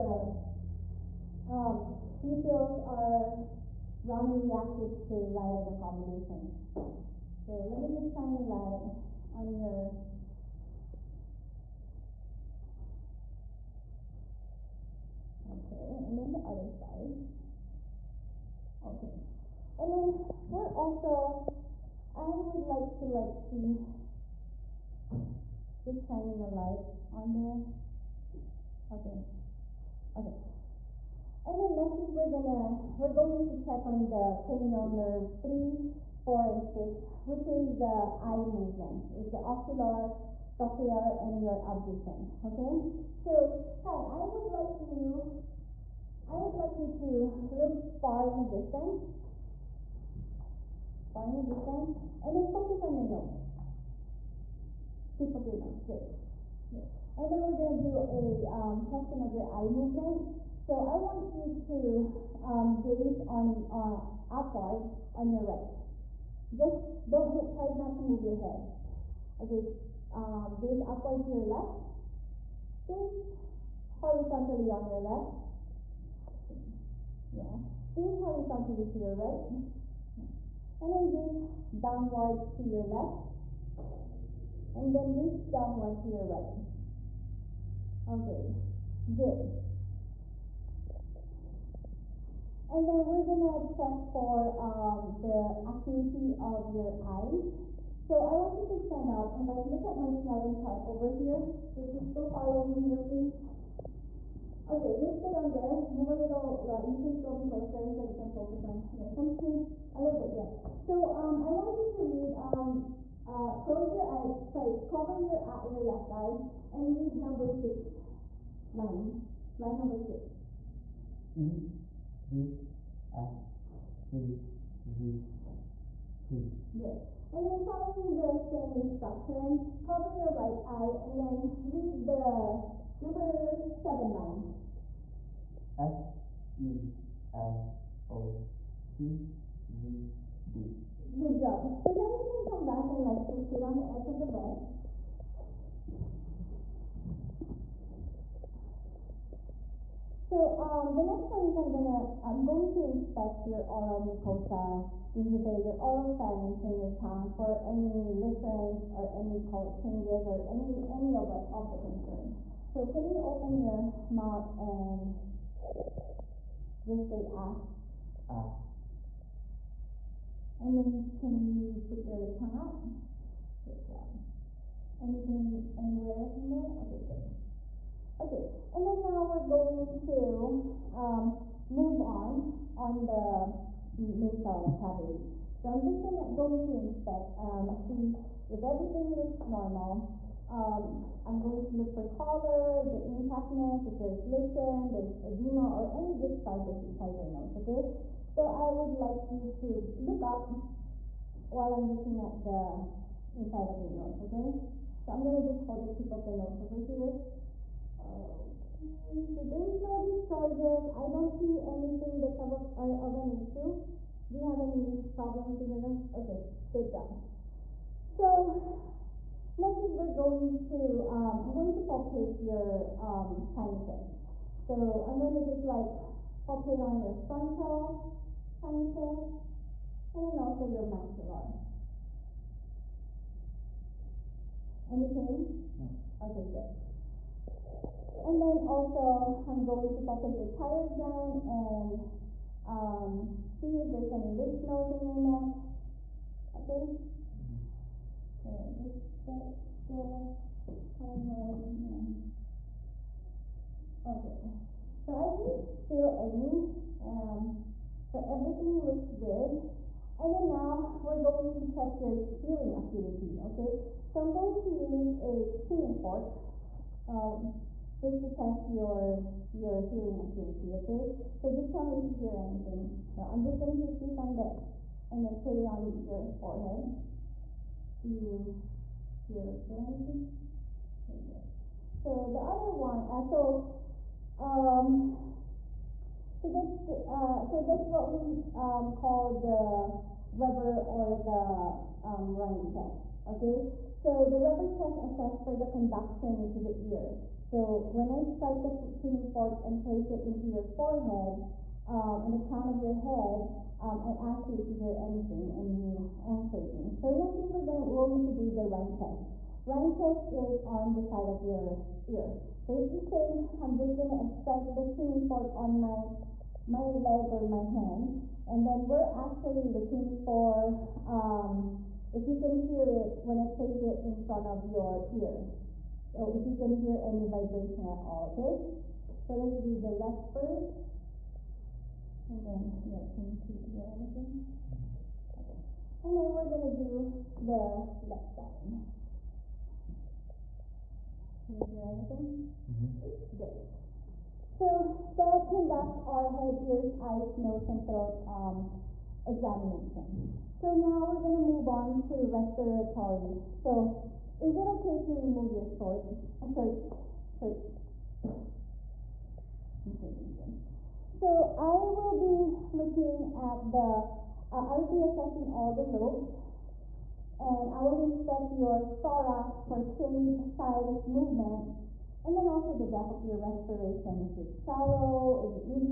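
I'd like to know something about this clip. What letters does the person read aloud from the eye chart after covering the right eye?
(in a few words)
F E L O P Z D.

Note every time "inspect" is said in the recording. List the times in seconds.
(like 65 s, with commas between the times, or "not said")
152 s, 186 s, 367 s.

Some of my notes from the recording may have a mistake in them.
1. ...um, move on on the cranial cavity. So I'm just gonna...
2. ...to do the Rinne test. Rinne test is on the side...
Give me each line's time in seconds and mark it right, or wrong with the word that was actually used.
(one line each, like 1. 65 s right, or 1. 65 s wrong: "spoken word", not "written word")
1. 180 s wrong: "nasal", not "cranial"
2. 308 s right.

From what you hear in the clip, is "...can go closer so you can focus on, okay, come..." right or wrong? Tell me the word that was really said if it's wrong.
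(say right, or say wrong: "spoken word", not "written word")
right.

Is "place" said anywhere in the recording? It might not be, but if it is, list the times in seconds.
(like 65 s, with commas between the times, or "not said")
299 s, 323 s.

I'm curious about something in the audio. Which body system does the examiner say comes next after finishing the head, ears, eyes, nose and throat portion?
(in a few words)
Respiratory.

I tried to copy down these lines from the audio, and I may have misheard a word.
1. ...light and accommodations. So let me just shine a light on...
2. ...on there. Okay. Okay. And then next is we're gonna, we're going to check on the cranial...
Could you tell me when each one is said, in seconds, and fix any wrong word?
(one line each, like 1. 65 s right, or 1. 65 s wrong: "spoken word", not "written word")
1. 5 s right
2. 27 s right.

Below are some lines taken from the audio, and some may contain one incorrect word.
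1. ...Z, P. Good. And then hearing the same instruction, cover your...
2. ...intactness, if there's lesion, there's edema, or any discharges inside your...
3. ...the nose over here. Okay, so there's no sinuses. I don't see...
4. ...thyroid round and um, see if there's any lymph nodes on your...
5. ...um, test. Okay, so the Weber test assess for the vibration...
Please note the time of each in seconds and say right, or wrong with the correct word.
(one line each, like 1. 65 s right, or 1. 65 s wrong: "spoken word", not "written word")
1. 124 s wrong: "following", not "hearing"
2. 193 s right
3. 206 s wrong: "discharges", not "sinuses"
4. 240 s wrong: "gland", not "round"
5. 292 s wrong: "conduction", not "vibration".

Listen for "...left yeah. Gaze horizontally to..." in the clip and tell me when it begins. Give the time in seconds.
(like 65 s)
74 s.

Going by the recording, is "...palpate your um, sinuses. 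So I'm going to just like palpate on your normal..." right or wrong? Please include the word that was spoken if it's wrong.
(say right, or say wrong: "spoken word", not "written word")
wrong: "frontal", not "normal".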